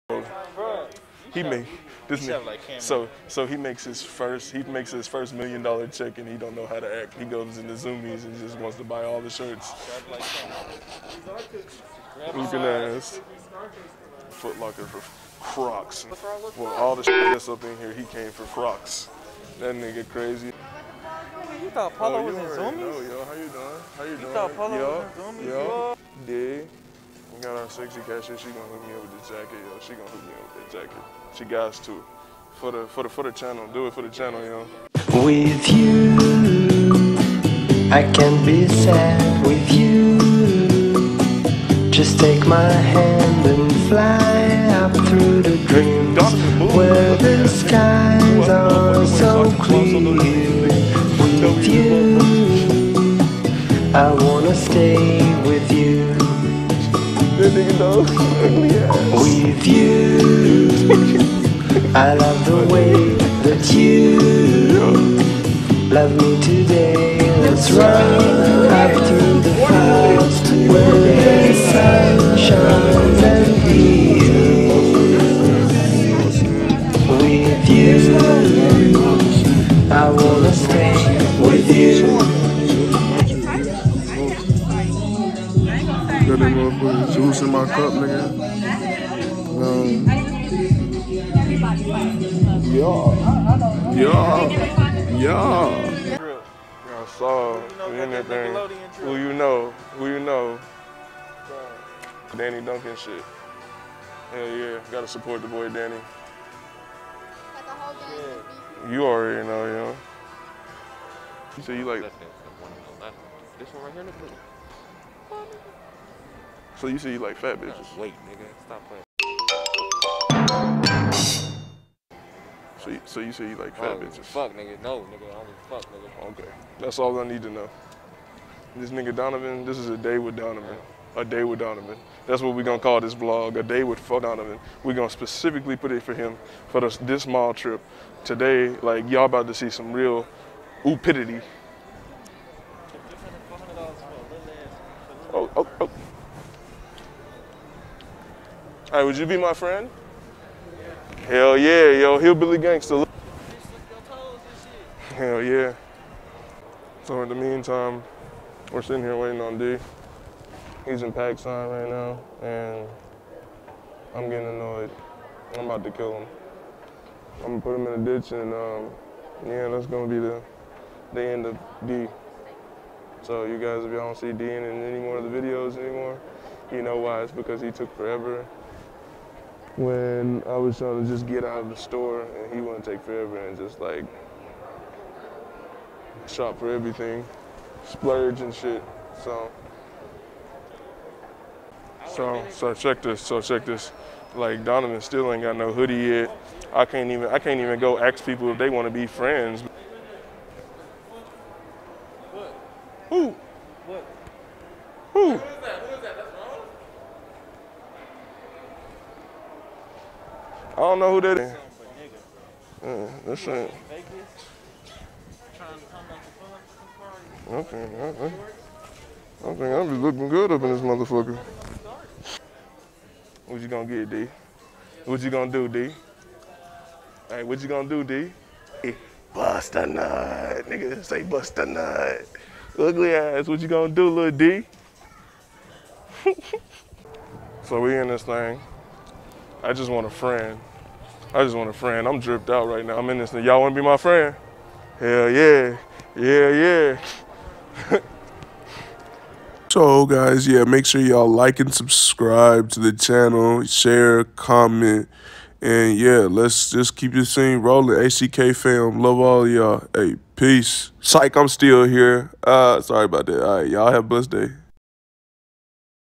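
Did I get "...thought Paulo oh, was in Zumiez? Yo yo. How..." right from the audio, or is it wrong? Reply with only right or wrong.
right.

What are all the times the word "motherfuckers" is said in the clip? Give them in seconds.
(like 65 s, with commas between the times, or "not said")
86 s, 220 s.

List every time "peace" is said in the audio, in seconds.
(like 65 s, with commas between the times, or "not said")
260 s.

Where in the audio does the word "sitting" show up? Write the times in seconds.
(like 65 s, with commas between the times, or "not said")
158 s.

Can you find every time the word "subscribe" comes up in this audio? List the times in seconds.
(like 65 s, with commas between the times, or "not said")
251 s.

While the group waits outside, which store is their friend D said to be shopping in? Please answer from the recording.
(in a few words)
PacSun.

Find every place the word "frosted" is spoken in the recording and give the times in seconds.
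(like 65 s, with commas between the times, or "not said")
not said.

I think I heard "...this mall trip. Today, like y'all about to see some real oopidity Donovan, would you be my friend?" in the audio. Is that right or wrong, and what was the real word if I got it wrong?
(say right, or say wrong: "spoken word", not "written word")
wrong: "Hey", not "Donovan".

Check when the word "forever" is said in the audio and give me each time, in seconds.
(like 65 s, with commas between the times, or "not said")
177 s, 183 s.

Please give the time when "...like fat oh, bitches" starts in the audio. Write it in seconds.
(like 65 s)
123 s.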